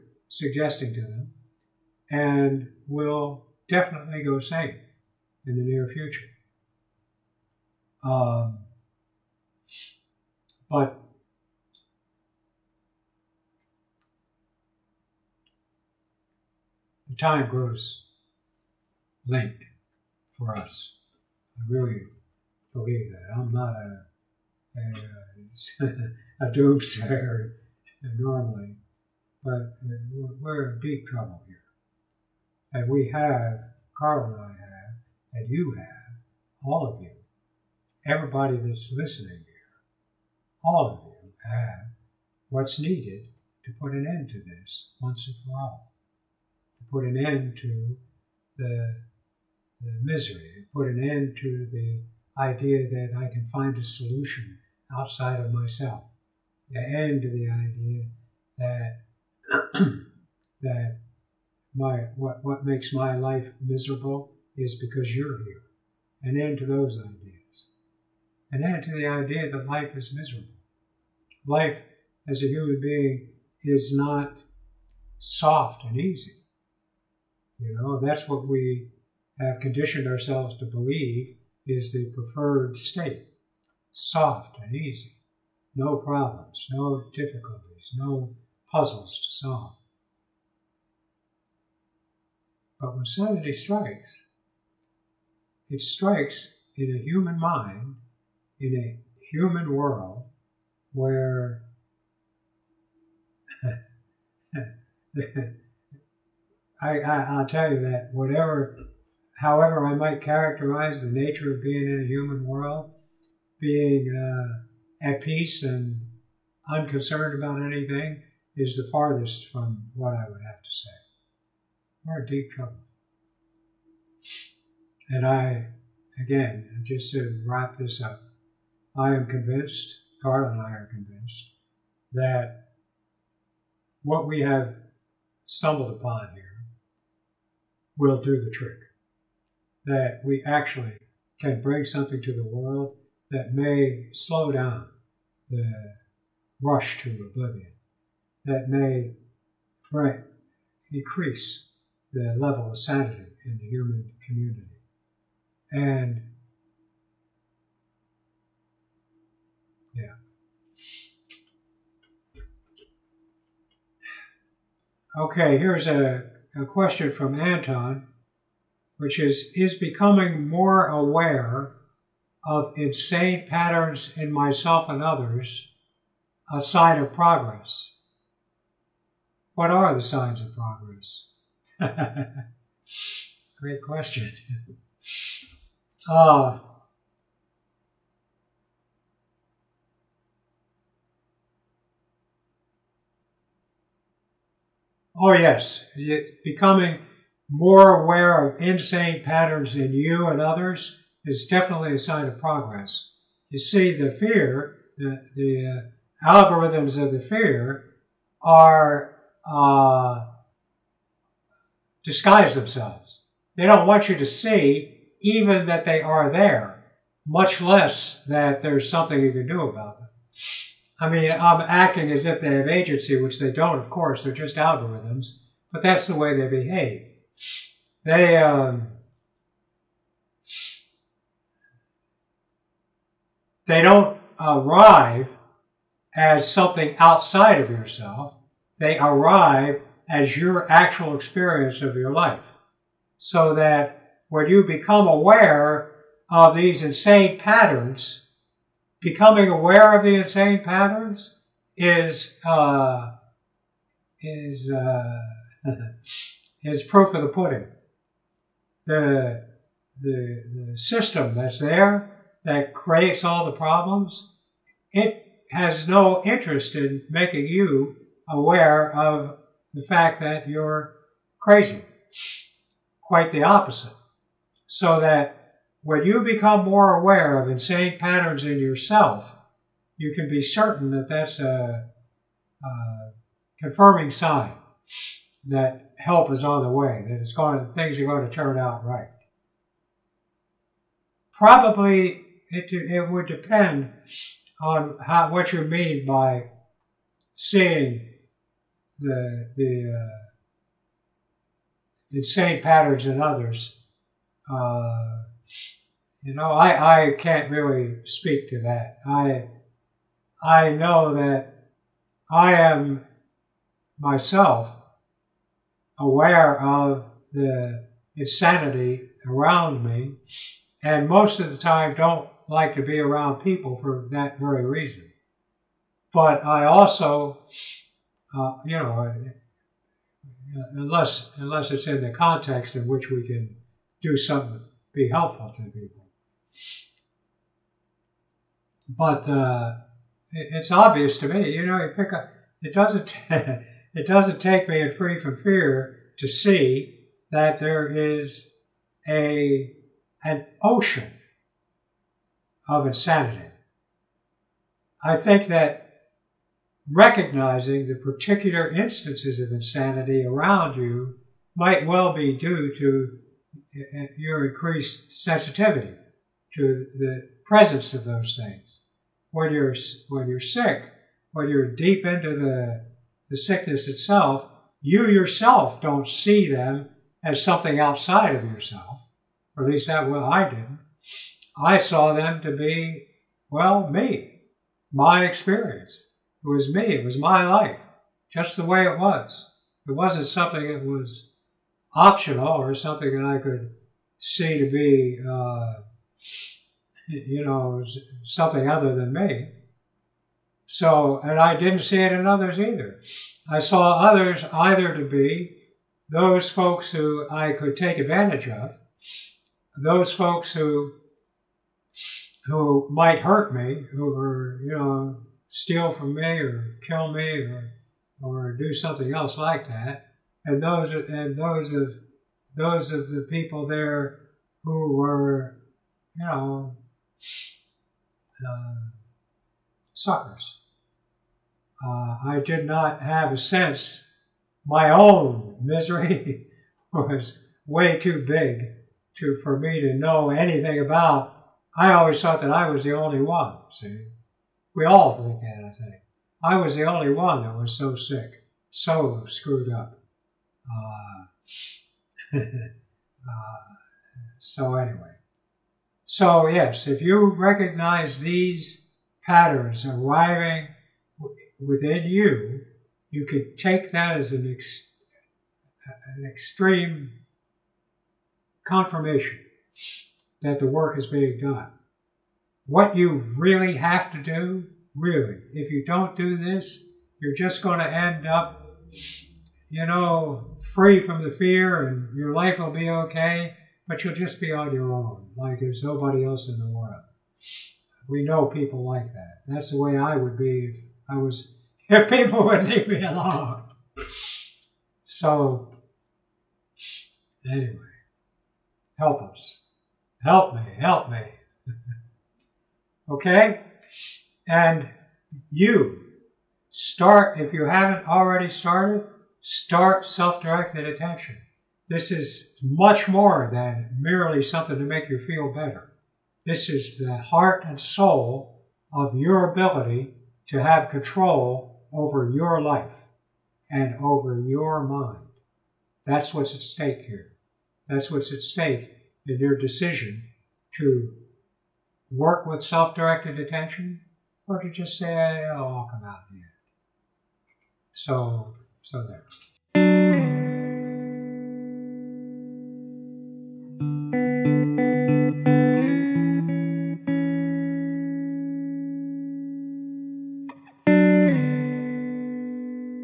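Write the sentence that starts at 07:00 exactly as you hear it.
And those and those of those of the people there who were, you know, uh, suckers.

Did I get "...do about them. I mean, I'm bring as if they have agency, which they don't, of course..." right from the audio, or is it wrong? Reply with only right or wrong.
wrong.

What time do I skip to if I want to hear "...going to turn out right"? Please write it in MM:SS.
04:48.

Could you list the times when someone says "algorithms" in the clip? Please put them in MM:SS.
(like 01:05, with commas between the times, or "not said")
03:26, 03:44.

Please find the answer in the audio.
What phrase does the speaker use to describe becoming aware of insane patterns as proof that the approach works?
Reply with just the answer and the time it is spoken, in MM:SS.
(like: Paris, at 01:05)
proof of the pudding, at 04:16.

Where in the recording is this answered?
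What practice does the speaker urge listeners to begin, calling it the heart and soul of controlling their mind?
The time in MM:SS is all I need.
08:30.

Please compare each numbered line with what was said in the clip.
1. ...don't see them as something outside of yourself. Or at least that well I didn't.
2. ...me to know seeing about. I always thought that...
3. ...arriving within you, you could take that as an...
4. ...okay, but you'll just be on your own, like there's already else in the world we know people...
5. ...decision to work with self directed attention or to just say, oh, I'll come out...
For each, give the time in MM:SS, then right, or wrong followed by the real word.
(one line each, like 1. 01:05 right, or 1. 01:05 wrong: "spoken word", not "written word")
1. 06:15 right
2. 07:19 wrong: "anything", not "seeing"
3. 07:39 right
4. 08:02 wrong: "nobody", not "already"
5. 08:49 right.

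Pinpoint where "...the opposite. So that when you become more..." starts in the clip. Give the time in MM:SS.
04:33.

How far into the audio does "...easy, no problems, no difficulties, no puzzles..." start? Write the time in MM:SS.
01:24.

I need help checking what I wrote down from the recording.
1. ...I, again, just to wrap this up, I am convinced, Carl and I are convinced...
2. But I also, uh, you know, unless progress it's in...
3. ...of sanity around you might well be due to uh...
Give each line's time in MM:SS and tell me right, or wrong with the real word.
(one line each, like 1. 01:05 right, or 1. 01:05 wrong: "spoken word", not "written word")
1. 02:05 right
2. 05:26 wrong: "unless", not "progress"
3. 05:59 wrong: "insanity", not "sanity".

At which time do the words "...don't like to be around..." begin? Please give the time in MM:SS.
05:21.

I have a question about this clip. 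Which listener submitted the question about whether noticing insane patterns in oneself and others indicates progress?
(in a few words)
Anton.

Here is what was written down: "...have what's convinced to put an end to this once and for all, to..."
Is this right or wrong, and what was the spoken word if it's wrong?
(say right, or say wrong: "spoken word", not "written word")
wrong: "needed", not "convinced".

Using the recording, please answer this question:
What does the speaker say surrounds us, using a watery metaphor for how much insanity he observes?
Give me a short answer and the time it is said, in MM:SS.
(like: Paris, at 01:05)
an ocean, at 05:50.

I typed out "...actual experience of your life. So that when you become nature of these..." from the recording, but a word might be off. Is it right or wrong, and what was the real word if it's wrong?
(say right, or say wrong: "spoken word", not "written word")
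wrong: "aware", not "nature".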